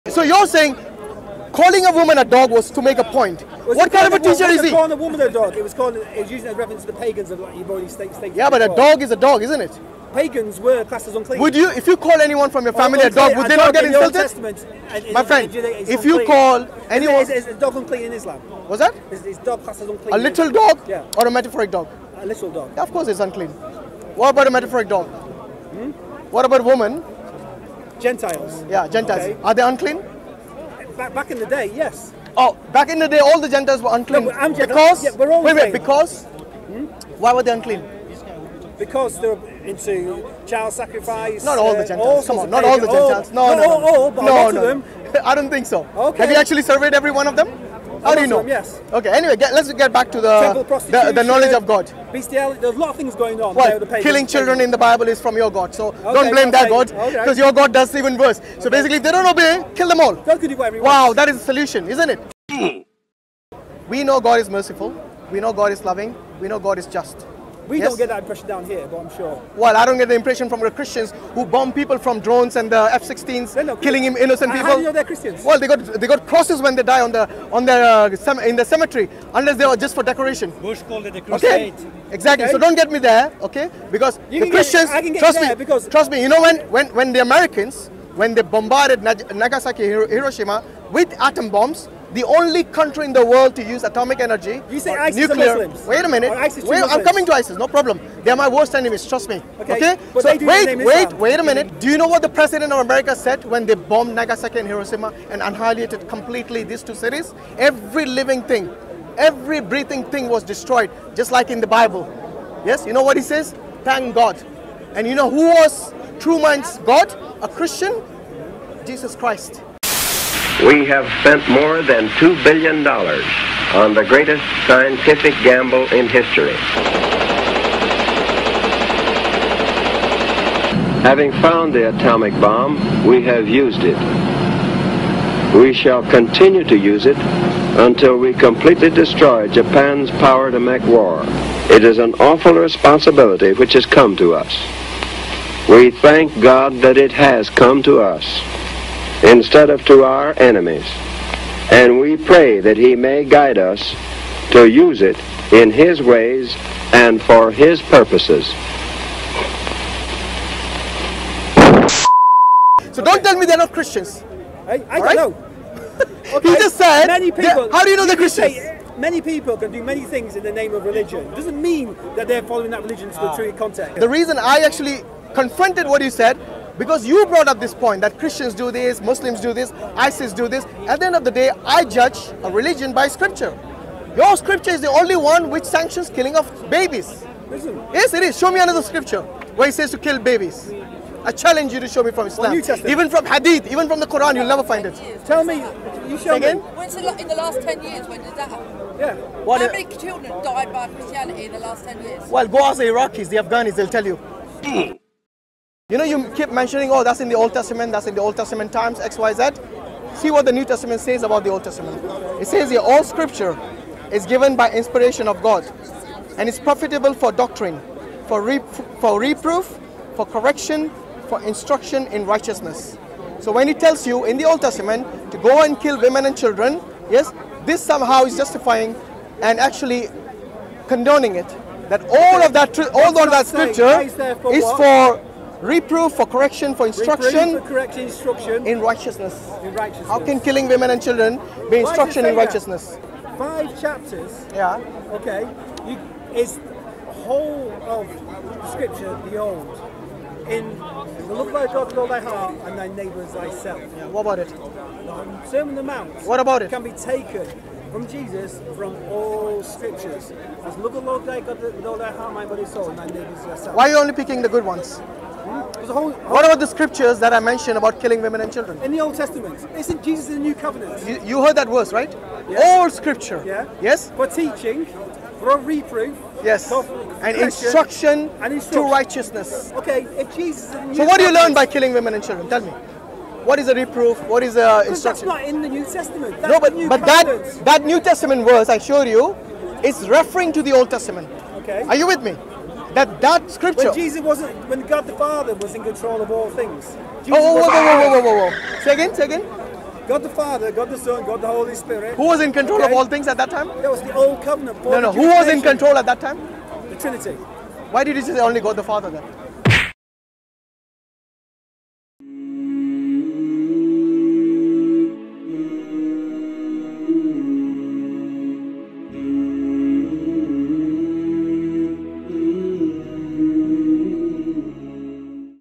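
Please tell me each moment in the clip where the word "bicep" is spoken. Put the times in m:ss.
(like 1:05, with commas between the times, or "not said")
not said.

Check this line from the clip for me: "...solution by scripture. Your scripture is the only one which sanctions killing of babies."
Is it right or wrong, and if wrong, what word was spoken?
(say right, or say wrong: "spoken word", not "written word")
wrong: "religion", not "solution".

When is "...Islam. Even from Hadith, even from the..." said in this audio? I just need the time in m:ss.
3:12.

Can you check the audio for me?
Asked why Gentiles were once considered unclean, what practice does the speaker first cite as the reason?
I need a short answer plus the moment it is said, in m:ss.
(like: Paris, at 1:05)
Child sacrifice, at 0:40.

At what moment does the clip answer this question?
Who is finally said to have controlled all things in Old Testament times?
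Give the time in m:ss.
5:06.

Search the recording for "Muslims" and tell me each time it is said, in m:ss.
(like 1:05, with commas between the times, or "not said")
1:35, 2:59.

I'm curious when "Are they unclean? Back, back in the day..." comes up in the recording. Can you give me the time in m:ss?
0:29.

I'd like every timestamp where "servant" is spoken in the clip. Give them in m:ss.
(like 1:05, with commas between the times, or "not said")
not said.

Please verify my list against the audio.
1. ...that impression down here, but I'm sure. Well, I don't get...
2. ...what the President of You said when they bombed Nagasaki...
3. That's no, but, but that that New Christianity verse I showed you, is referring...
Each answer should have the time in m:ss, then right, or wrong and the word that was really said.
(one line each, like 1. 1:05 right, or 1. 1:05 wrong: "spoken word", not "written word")
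1. 1:08 right
2. 1:42 wrong: "America", not "You"
3. 4:46 wrong: "Testament", not "Christianity".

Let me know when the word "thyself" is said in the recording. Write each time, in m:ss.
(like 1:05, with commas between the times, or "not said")
4:13, 4:23.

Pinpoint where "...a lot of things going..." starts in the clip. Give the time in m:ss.
0:52.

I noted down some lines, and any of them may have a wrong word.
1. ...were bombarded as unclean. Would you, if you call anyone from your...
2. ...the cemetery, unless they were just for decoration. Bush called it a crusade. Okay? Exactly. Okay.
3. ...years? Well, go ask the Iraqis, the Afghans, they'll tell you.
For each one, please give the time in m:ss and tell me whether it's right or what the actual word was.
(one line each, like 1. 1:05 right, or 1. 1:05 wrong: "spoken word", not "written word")
1. 0:10 wrong: "classed", not "bombarded"
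2. 1:18 right
3. 3:22 right.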